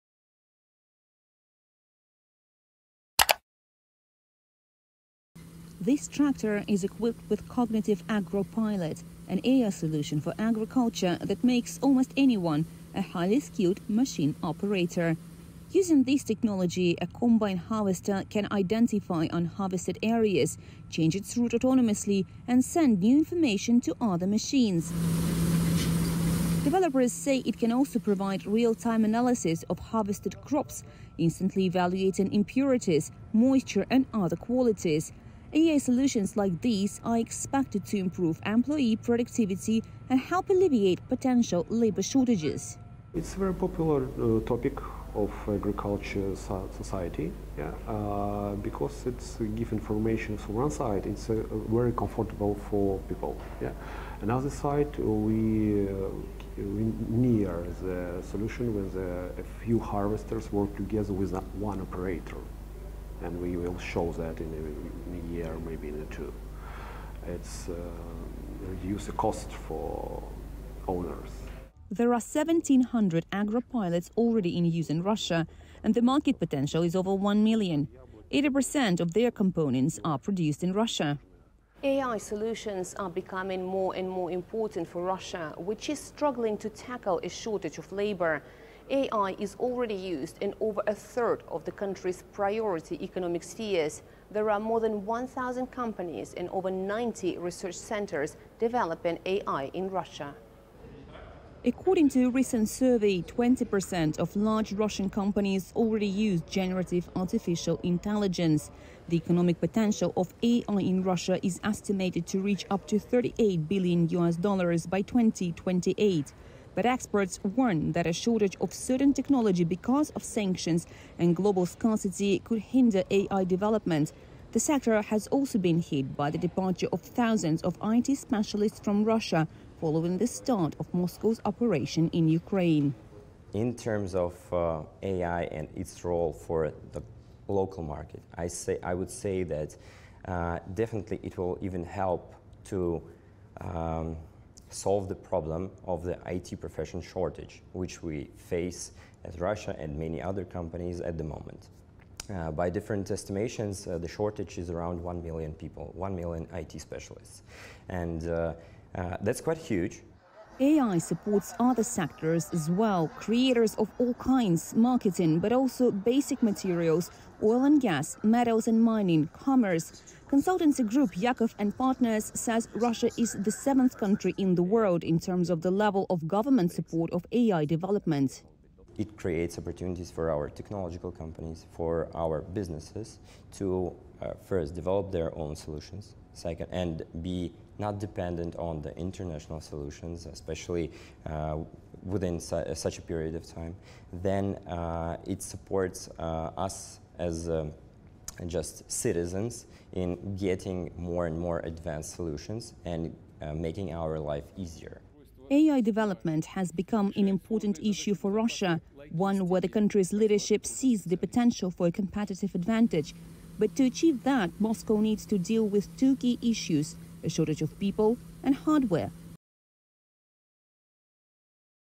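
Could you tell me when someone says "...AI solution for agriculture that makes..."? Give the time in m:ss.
0:09.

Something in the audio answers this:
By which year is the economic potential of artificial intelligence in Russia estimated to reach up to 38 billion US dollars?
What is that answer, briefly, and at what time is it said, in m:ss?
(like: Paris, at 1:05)
2028, at 1:55.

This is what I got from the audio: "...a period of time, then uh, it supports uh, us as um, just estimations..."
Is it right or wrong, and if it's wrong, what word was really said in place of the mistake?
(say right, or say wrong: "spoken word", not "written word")
wrong: "citizens", not "estimations".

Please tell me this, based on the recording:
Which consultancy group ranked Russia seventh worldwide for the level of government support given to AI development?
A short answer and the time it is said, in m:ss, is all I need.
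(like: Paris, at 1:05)
Yakov and Partners, at 2:51.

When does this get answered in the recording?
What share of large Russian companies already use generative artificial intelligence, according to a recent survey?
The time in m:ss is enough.
1:43.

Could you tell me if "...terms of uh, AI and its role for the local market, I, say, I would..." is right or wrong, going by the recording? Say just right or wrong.
right.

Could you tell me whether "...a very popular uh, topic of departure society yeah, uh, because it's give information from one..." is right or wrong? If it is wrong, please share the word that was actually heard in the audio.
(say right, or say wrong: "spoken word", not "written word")
wrong: "agriculture", not "departure".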